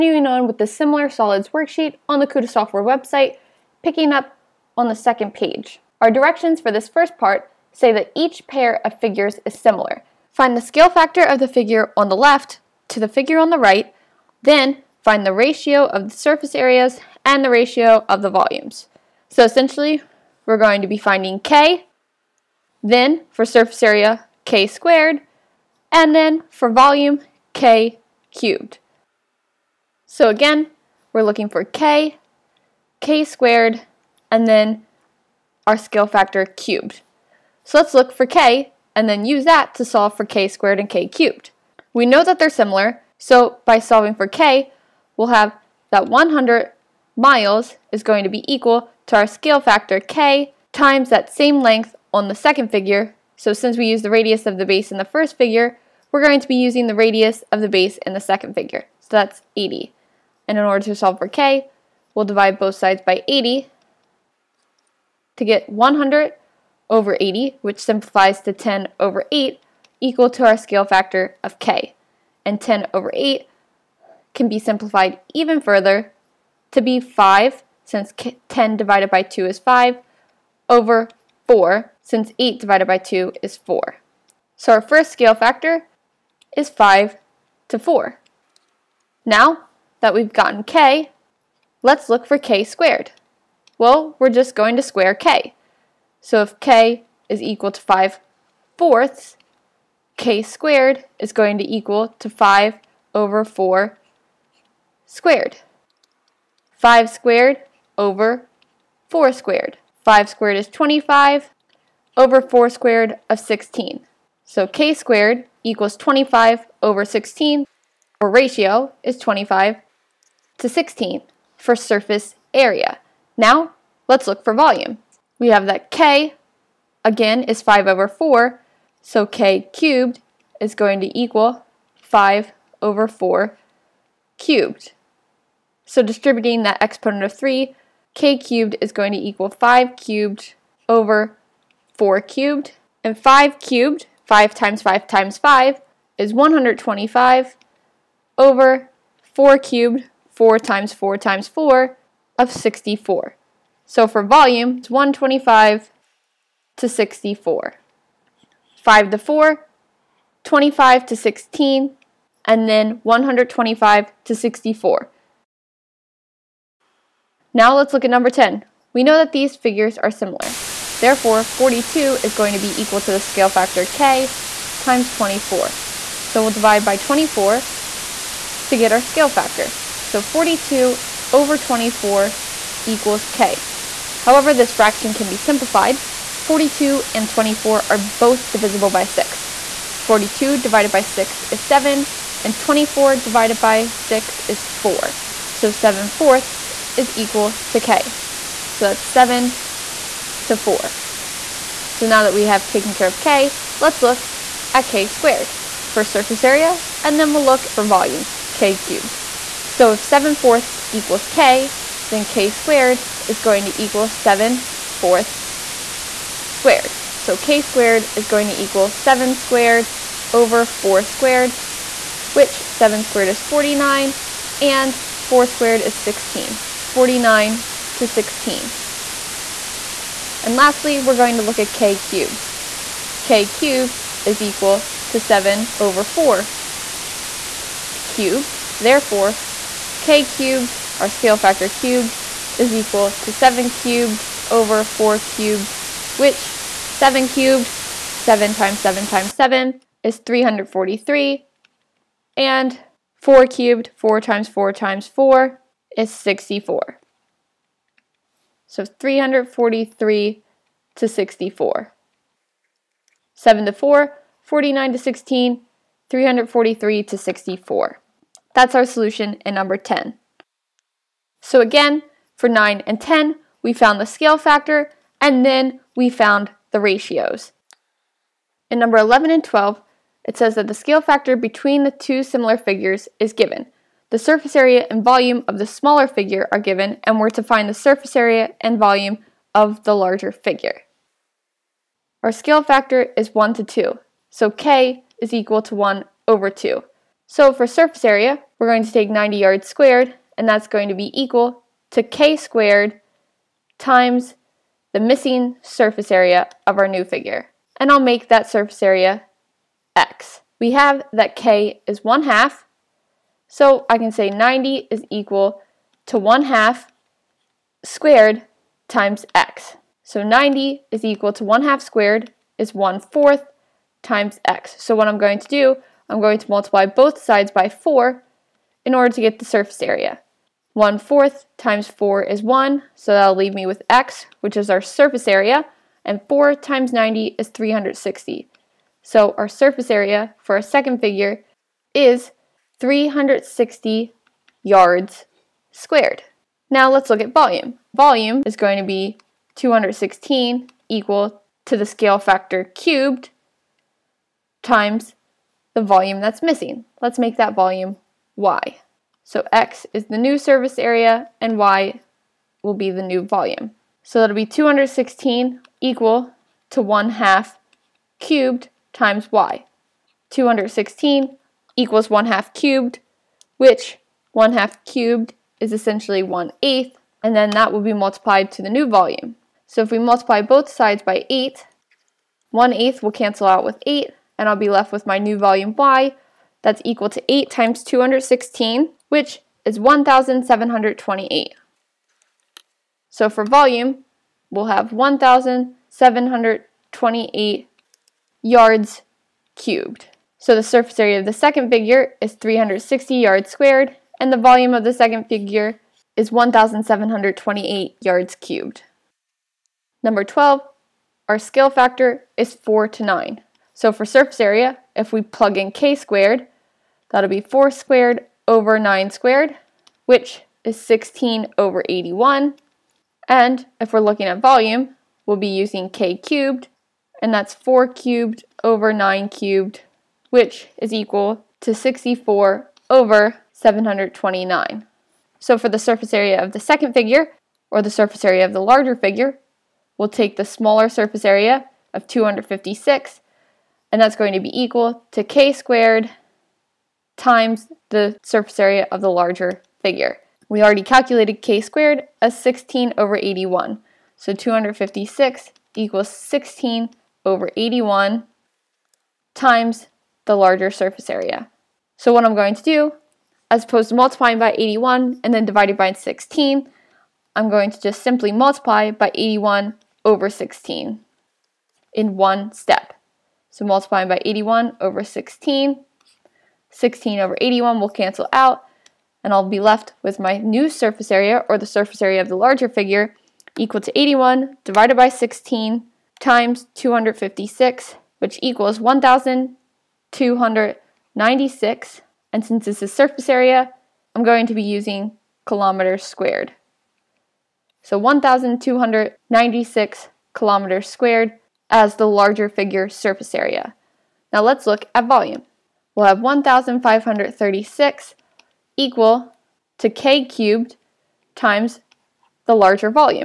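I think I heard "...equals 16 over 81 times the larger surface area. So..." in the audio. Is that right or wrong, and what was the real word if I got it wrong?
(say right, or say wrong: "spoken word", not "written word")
right.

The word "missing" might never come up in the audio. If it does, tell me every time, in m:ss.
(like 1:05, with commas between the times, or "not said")
5:04, 5:56.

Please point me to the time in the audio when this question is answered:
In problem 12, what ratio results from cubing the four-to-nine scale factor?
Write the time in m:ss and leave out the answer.
7:11.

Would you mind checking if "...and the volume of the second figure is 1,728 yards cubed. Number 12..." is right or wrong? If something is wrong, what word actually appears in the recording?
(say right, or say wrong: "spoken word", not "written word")
right.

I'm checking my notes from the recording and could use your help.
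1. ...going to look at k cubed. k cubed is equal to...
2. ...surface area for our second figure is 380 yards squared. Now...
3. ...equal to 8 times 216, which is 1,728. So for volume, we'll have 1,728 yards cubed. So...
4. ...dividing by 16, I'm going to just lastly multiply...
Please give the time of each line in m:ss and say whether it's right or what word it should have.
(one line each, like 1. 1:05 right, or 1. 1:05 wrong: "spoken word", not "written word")
1. 3:51 right
2. 5:39 wrong: "360", not "380"
3. 6:26 right
4. 7:45 wrong: "simply", not "lastly".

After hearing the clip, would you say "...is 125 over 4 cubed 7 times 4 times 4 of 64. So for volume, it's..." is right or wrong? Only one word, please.
wrong.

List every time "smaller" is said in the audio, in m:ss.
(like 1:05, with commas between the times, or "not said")
4:45, 7:20.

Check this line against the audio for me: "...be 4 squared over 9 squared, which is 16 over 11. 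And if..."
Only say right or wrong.
wrong.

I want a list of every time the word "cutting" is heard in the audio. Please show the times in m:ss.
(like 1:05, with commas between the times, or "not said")
not said.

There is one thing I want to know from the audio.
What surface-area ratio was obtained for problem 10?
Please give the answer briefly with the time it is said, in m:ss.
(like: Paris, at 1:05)
49 to 16, at 3:46.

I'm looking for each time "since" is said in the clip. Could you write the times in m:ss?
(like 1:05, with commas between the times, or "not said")
0:53, 1:17, 1:22, 8:12.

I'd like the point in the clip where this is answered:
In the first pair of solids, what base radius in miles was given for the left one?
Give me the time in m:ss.
0:46.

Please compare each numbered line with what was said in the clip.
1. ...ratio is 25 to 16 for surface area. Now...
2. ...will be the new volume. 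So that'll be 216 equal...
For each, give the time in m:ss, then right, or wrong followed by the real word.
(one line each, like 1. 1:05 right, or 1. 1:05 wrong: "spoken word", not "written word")
1. 1:58 right
2. 6:02 right.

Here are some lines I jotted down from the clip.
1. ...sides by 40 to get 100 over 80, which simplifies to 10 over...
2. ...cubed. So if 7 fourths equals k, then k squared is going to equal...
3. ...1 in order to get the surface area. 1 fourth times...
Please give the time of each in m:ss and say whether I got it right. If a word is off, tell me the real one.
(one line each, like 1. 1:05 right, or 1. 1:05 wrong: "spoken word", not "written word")
1. 1:02 wrong: "80", not "40"
2. 3:28 right
3. 5:27 wrong: "4", not "1".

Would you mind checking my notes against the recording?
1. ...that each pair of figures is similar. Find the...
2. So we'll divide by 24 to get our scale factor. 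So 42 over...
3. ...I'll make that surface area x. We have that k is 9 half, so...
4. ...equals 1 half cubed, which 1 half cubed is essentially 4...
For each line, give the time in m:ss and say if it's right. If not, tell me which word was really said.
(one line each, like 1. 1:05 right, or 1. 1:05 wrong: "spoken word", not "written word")
1. 0:07 right
2. 2:56 right
3. 5:07 wrong: "1", not "9"
4. 6:11 wrong: "1", not "4".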